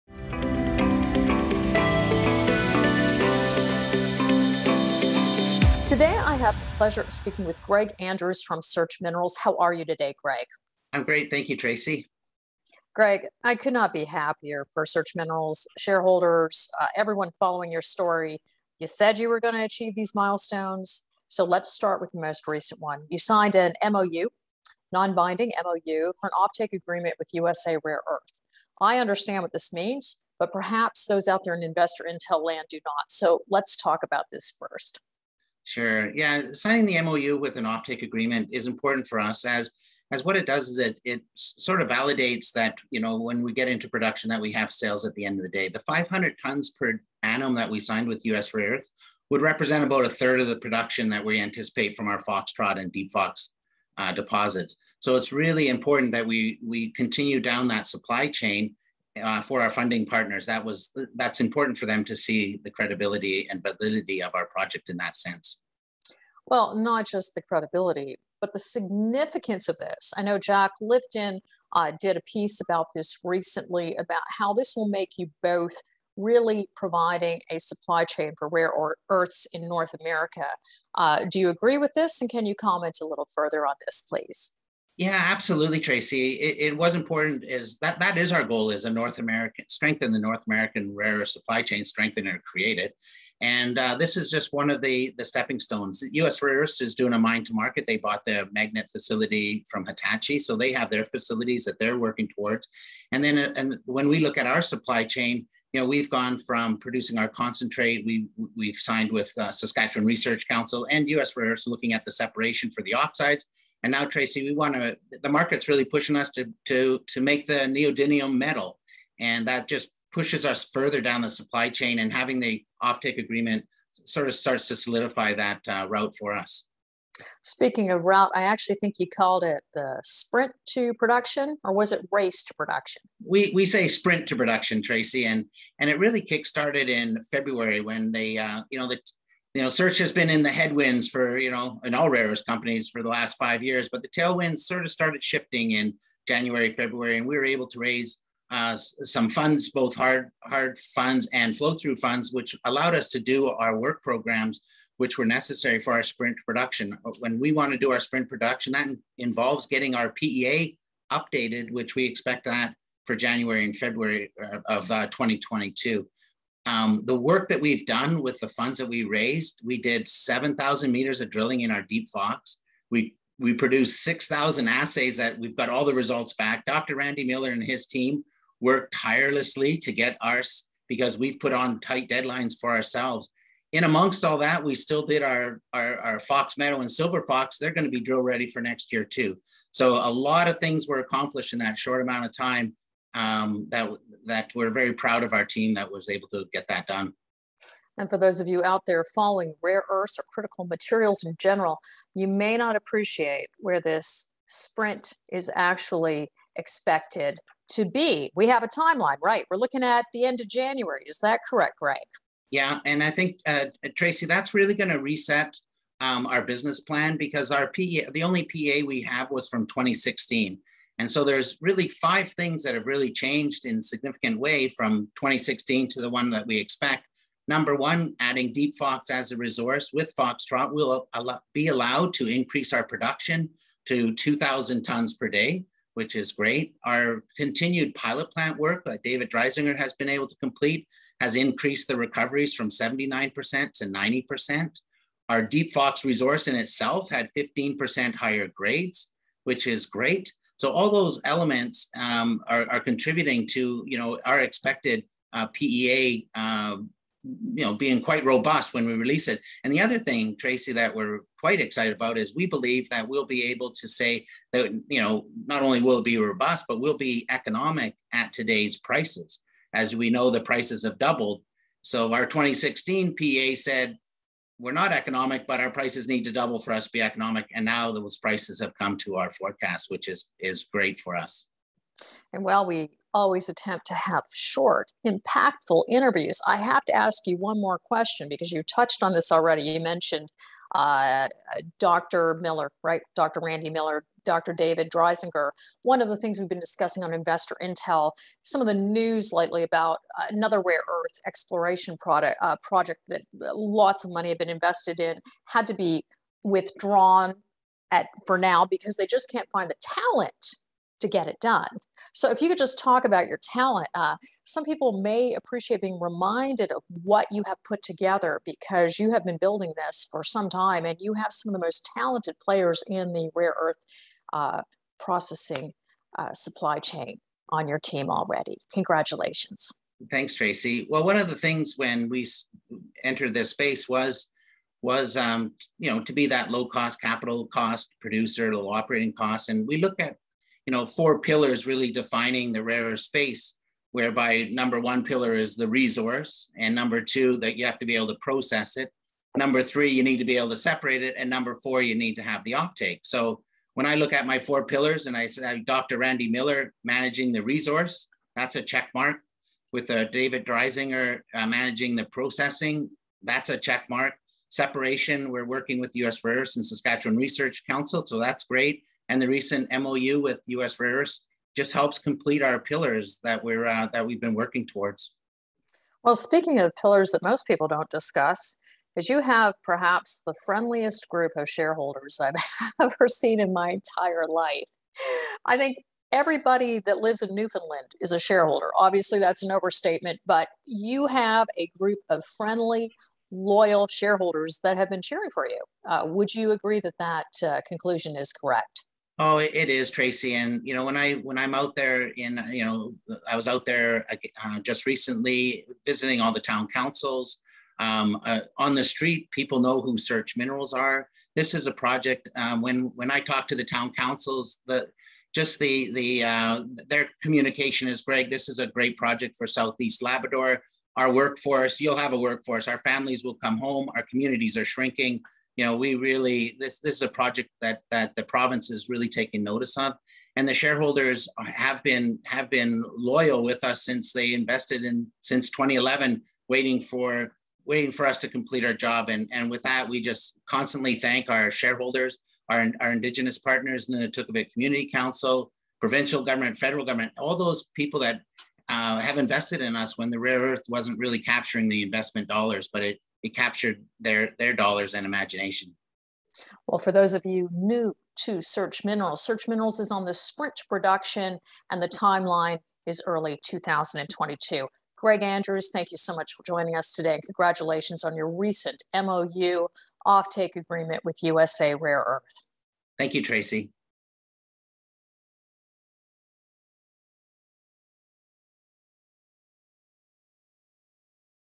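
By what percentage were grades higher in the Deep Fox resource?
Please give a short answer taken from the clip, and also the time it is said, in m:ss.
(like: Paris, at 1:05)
15%, at 4:07.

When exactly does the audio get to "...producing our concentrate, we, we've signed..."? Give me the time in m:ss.
1:46.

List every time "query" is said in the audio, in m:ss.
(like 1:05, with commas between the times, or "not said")
not said.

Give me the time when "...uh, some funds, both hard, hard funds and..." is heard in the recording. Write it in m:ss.
2:28.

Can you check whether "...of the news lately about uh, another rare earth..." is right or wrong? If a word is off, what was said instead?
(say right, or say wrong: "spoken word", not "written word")
right.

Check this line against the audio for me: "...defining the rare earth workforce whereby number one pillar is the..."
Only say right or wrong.
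wrong.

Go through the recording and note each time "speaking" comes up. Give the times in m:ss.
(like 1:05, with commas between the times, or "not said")
0:07, 2:07, 6:16.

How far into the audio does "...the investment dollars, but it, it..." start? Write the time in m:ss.
7:31.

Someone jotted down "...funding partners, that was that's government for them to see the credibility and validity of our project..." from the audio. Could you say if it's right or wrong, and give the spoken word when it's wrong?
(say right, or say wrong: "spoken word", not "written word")
wrong: "important", not "government".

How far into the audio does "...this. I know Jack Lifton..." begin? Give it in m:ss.
1:09.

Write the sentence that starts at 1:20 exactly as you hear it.
Uh, do you agree with this?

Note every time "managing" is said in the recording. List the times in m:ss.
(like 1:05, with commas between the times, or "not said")
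5:56, 6:01.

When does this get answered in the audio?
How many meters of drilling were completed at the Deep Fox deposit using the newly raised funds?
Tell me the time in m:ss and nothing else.
2:50.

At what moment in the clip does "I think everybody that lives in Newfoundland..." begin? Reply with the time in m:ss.
6:25.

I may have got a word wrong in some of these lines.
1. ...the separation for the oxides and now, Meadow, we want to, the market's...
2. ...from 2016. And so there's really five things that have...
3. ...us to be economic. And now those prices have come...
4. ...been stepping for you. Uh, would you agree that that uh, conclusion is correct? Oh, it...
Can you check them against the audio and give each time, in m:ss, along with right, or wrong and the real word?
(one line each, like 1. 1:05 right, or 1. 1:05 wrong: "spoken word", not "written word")
1. 1:52 wrong: "Tracy", not "Meadow"
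2. 3:39 right
3. 4:36 right
4. 6:34 wrong: "cheering", not "stepping".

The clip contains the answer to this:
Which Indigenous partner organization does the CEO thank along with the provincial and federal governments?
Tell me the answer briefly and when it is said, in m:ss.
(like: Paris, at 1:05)
NunatuKavut Community Council, at 7:23.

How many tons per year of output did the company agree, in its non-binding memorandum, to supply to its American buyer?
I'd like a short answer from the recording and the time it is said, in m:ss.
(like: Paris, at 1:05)
500 tons per annum, at 0:45.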